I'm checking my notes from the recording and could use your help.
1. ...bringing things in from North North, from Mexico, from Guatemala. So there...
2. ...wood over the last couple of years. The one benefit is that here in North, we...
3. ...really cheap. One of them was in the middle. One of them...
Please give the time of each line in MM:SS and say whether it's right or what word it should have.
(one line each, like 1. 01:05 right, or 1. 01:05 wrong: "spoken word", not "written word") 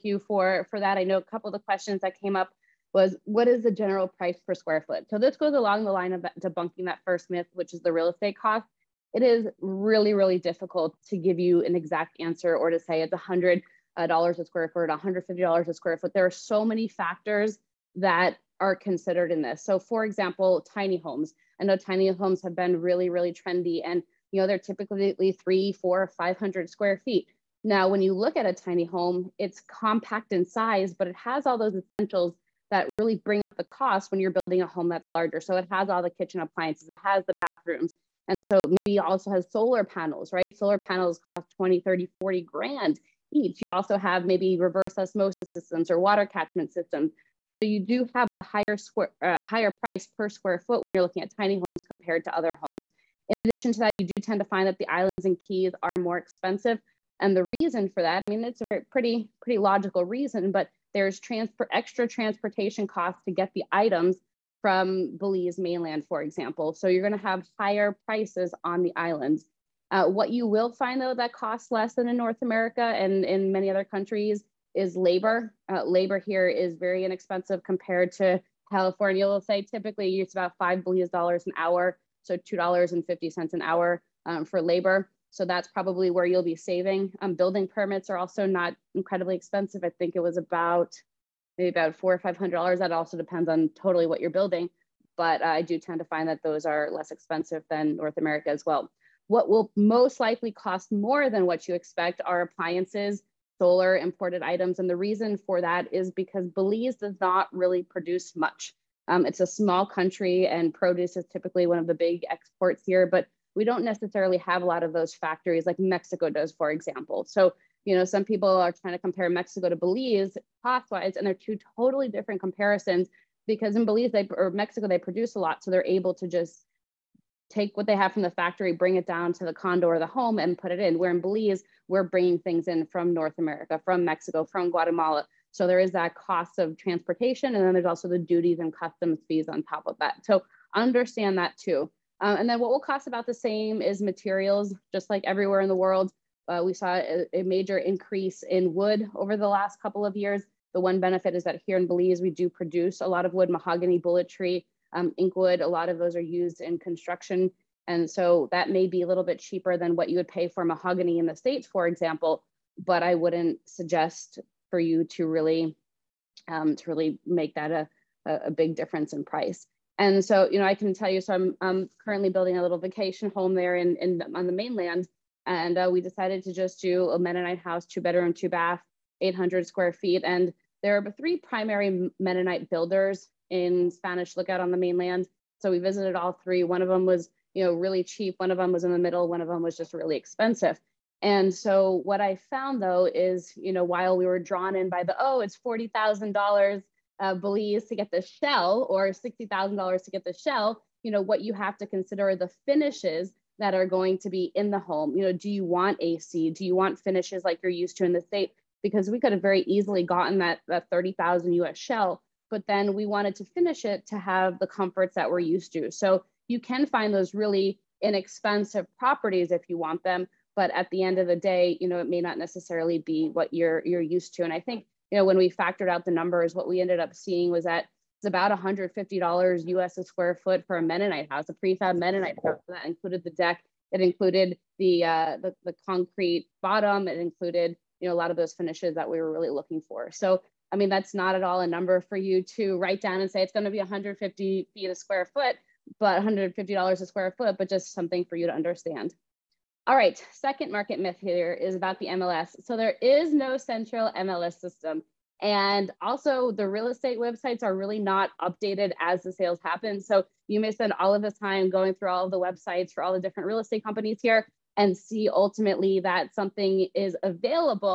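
1. 02:12 wrong: "America", not "North"
2. 02:28 wrong: "Belize", not "North"
3. 03:07 right.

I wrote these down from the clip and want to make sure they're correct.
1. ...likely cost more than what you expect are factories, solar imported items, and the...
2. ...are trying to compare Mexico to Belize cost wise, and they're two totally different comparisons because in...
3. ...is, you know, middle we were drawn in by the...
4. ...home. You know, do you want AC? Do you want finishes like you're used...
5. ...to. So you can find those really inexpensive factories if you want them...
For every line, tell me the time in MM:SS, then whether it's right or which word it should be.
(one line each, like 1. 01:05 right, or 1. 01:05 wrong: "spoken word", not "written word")
1. 01:40 wrong: "appliances", not "factories"
2. 01:58 right
3. 03:13 wrong: "while", not "middle"
4. 03:24 right
5. 03:35 wrong: "properties", not "factories".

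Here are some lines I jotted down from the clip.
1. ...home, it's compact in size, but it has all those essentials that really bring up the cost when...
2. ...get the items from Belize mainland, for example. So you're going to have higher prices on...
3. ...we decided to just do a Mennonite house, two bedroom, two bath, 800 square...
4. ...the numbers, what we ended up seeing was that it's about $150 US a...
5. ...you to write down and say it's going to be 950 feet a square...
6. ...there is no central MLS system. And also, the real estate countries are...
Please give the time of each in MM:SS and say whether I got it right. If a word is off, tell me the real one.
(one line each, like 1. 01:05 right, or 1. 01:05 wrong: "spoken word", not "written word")
1. 00:28 right
2. 01:03 right
3. 02:55 right
4. 03:46 right
5. 04:02 wrong: "150", not "950"
6. 04:12 wrong: "websites", not "countries".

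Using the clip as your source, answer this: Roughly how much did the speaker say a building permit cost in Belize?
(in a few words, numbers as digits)
$400-500.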